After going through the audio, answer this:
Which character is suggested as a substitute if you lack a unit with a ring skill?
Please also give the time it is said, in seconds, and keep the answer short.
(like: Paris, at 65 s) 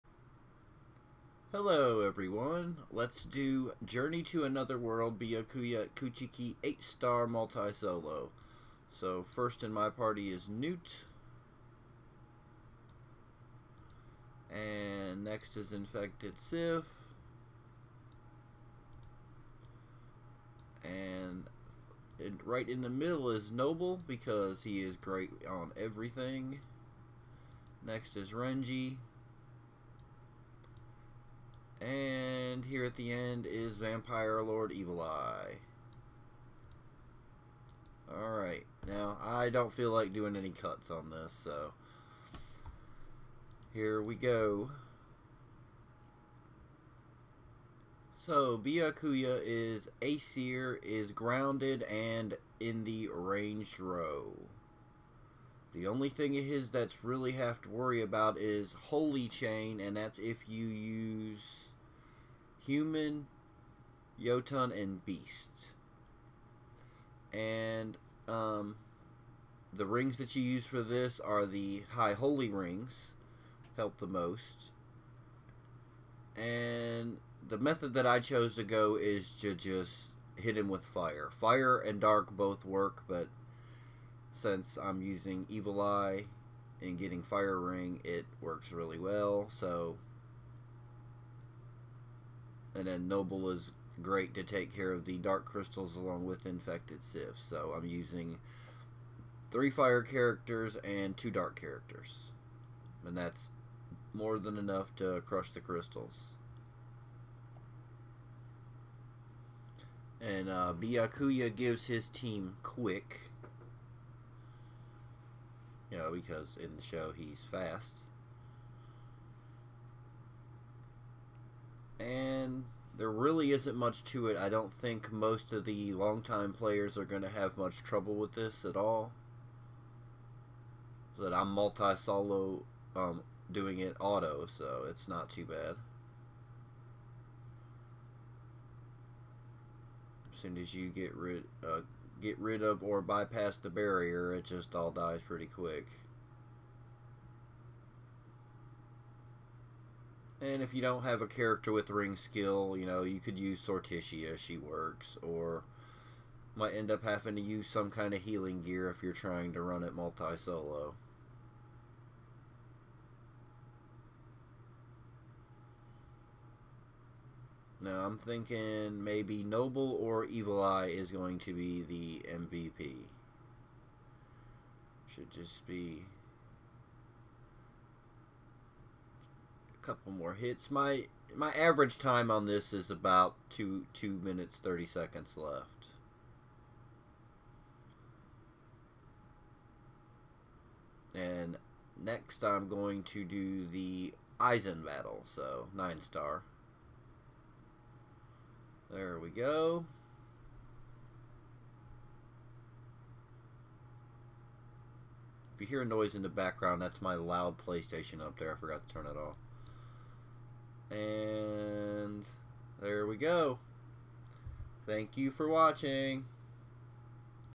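Sorticia, at 153 s.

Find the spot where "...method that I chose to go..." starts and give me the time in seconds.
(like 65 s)
77 s.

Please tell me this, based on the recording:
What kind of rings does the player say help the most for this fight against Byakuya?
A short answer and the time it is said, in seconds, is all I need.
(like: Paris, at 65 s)
High Holy rings, at 71 s.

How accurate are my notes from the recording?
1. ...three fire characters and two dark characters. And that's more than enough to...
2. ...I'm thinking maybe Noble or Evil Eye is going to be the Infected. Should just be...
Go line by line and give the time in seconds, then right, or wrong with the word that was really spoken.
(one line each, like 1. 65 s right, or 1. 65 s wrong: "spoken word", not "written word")
1. 99 s right
2. 168 s wrong: "MVP", not "Infected".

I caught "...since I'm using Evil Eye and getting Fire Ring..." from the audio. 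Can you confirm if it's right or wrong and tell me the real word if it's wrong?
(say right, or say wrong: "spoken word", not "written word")
right.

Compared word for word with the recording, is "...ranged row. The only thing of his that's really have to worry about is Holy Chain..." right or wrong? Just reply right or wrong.
right.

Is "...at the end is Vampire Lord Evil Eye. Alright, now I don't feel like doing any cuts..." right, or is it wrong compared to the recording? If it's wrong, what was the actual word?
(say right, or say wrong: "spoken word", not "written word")
right.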